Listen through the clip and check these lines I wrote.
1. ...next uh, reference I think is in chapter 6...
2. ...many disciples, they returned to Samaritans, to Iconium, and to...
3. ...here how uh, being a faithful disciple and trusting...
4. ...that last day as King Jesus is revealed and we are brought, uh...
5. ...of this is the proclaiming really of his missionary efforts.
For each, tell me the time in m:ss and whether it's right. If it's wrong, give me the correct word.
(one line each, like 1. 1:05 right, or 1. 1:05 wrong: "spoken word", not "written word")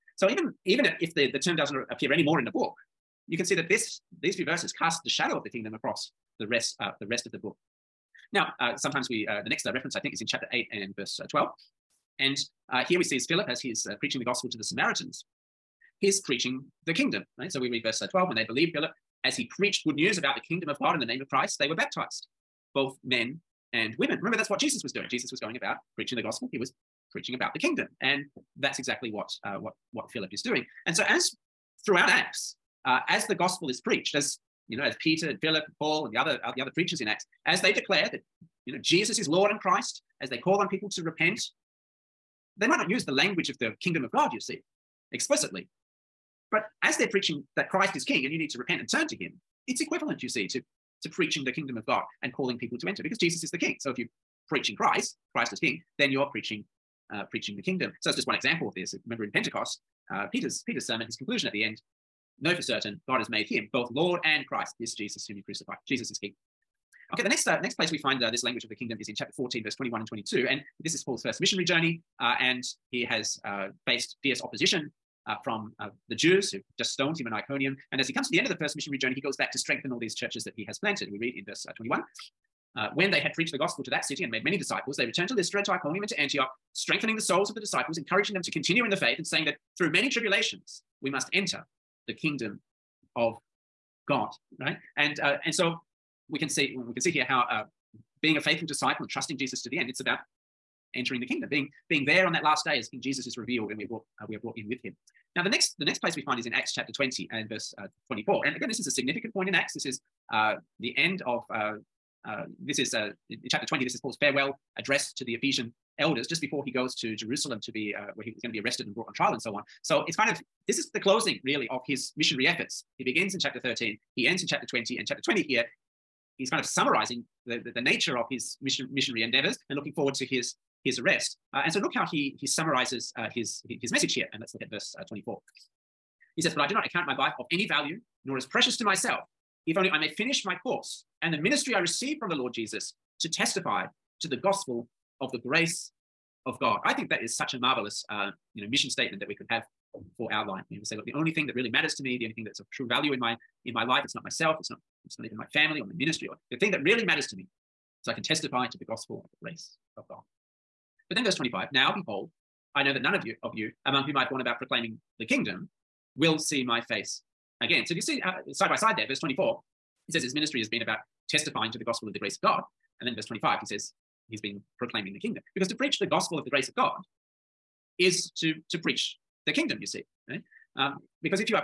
1. 0:09 wrong: "8", not "6"
2. 1:24 wrong: "Lystra", not "Samaritans"
3. 1:37 right
4. 1:42 right
5. 2:00 wrong: "closing", not "proclaiming".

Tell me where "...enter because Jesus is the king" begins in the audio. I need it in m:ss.
0:52.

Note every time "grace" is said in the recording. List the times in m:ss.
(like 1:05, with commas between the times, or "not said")
2:25, 2:39, 2:52, 2:56.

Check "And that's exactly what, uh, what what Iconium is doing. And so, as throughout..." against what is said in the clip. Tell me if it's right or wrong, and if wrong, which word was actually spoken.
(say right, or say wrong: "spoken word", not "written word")
wrong: "Philip", not "Iconium".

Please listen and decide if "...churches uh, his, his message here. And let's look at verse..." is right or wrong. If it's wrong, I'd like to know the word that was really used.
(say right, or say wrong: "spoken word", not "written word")
wrong: "summarizes", not "churches".